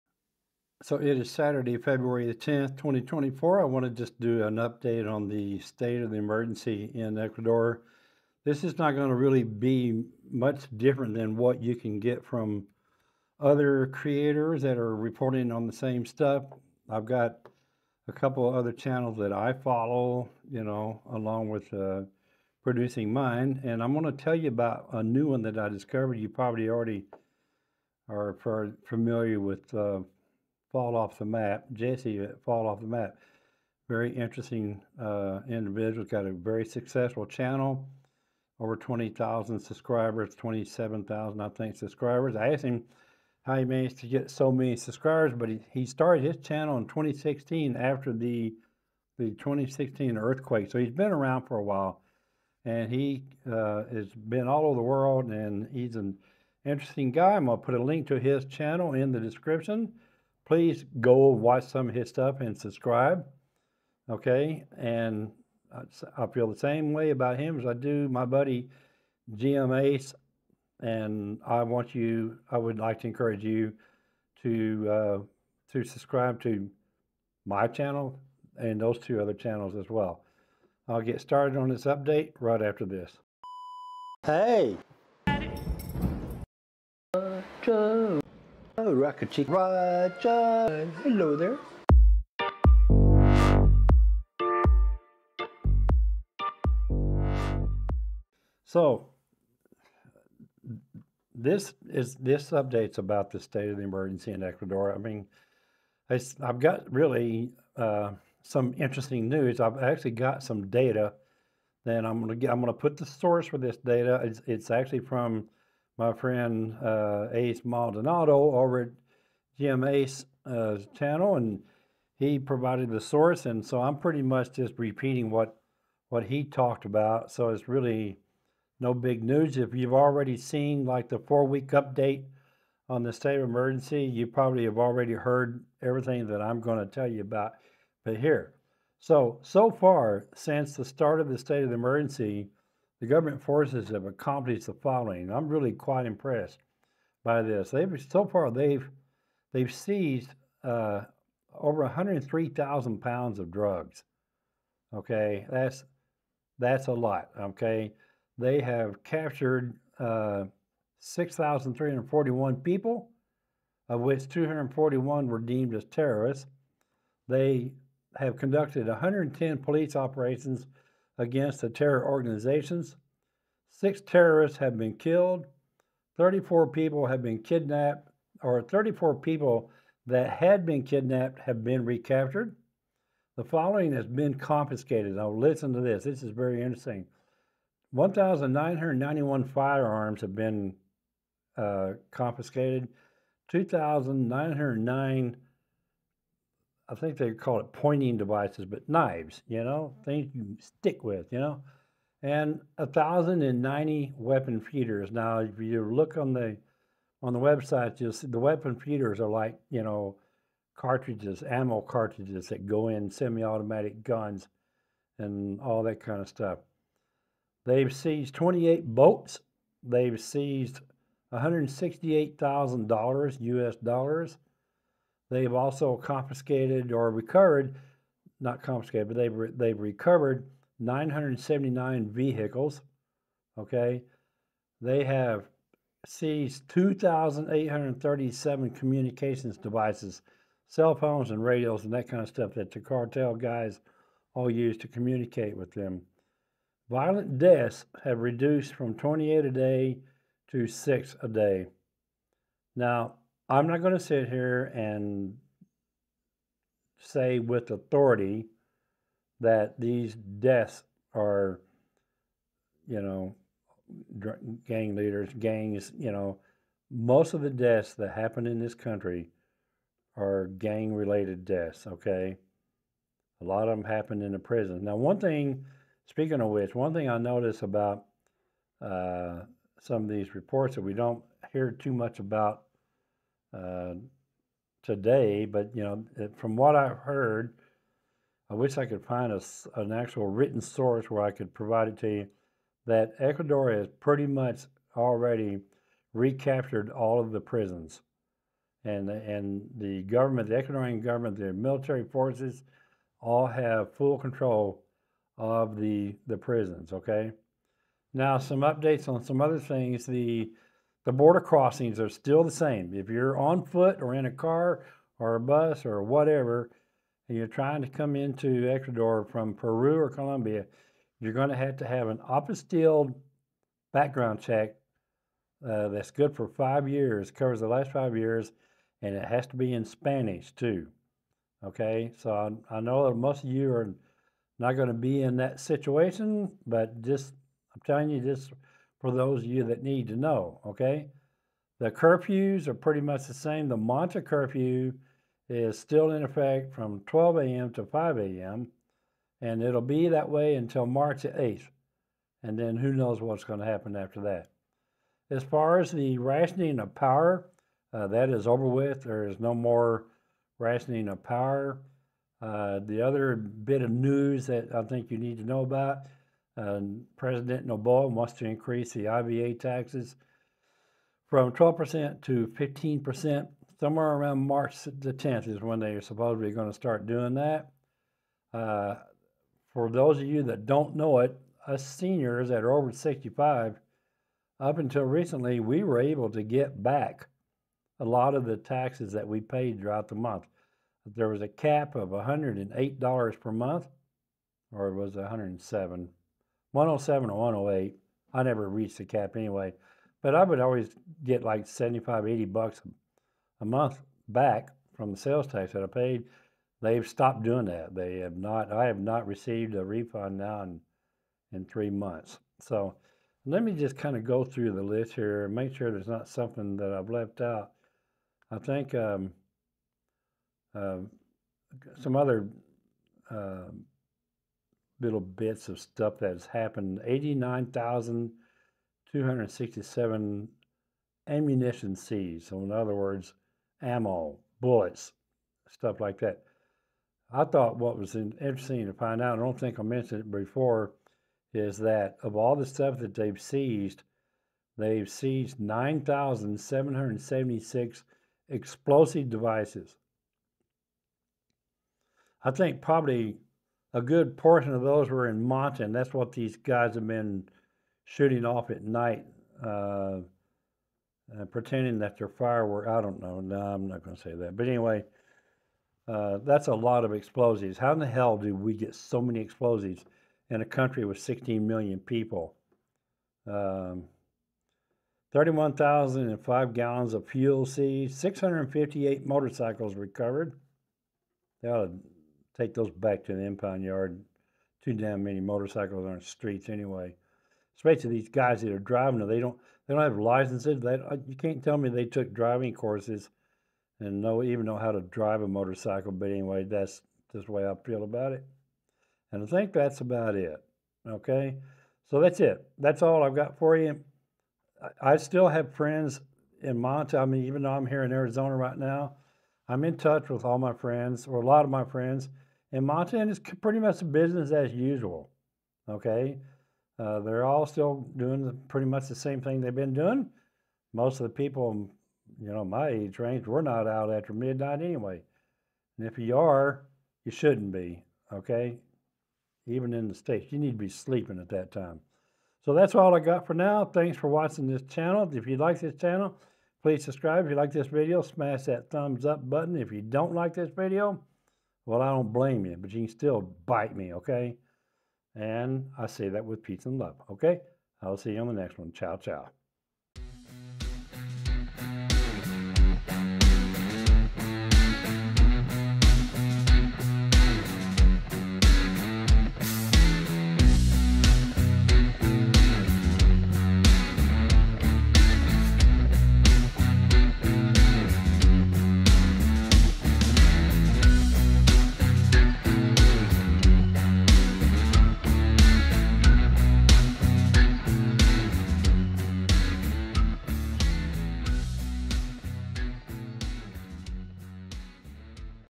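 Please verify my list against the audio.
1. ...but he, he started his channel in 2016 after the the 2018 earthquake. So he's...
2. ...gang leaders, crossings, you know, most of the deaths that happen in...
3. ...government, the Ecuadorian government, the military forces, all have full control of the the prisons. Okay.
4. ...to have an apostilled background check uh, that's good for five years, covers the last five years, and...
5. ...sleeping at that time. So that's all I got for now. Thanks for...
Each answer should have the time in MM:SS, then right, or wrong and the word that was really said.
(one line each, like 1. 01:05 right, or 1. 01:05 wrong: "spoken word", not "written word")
1. 00:45 wrong: "2016", not "2018"
2. 04:24 wrong: "gangs", not "crossings"
3. 05:00 right
4. 05:21 right
5. 08:50 right.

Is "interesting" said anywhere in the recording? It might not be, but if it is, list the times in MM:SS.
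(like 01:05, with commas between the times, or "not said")
00:34, 00:56, 01:48, 03:06, 07:18.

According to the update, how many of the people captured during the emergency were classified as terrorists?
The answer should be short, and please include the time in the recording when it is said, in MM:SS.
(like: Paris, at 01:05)
241, at 02:44.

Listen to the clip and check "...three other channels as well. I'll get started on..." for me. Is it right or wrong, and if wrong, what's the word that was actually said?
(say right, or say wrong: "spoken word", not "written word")
wrong: "two", not "three".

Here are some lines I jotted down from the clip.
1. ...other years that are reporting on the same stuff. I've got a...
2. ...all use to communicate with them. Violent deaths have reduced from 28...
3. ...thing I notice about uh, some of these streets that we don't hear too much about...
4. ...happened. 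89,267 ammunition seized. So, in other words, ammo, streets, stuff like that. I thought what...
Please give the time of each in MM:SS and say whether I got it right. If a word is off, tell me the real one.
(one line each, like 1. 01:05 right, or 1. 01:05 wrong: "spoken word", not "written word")
1. 00:13 wrong: "creators", not "years"
2. 04:04 right
3. 04:36 wrong: "reports", not "streets"
4. 07:06 wrong: "bullets", not "streets".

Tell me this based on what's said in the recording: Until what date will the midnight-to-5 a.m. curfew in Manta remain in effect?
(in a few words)
March 8th.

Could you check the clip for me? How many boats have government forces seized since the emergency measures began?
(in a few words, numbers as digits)
28.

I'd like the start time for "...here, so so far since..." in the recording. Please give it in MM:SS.
02:18.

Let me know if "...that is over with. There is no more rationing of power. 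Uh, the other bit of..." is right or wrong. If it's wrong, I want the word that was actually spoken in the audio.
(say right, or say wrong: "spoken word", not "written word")
right.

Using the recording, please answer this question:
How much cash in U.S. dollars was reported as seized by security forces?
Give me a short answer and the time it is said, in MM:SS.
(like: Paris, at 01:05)
$168,000, at 03:41.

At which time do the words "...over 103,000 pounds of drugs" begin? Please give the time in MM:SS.
02:31.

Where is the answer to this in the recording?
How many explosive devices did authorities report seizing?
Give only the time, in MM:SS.
07:25.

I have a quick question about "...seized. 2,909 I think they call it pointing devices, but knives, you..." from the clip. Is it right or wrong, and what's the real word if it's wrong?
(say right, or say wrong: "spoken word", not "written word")
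wrong: "confiscated", not "seized".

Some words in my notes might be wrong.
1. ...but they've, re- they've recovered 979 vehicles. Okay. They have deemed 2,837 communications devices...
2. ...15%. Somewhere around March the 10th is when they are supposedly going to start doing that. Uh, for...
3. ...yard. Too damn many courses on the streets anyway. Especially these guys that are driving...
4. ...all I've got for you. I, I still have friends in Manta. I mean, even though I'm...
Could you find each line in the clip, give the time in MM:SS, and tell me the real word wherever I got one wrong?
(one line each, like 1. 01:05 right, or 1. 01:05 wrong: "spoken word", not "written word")
1. 03:49 wrong: "seized", not "deemed"
2. 06:12 right
3. 08:03 wrong: "motorcycles", not "courses"
4. 08:23 right.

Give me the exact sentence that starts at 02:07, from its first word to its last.
So it's really no big news.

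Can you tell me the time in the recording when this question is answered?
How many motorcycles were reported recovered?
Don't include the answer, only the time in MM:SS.
07:58.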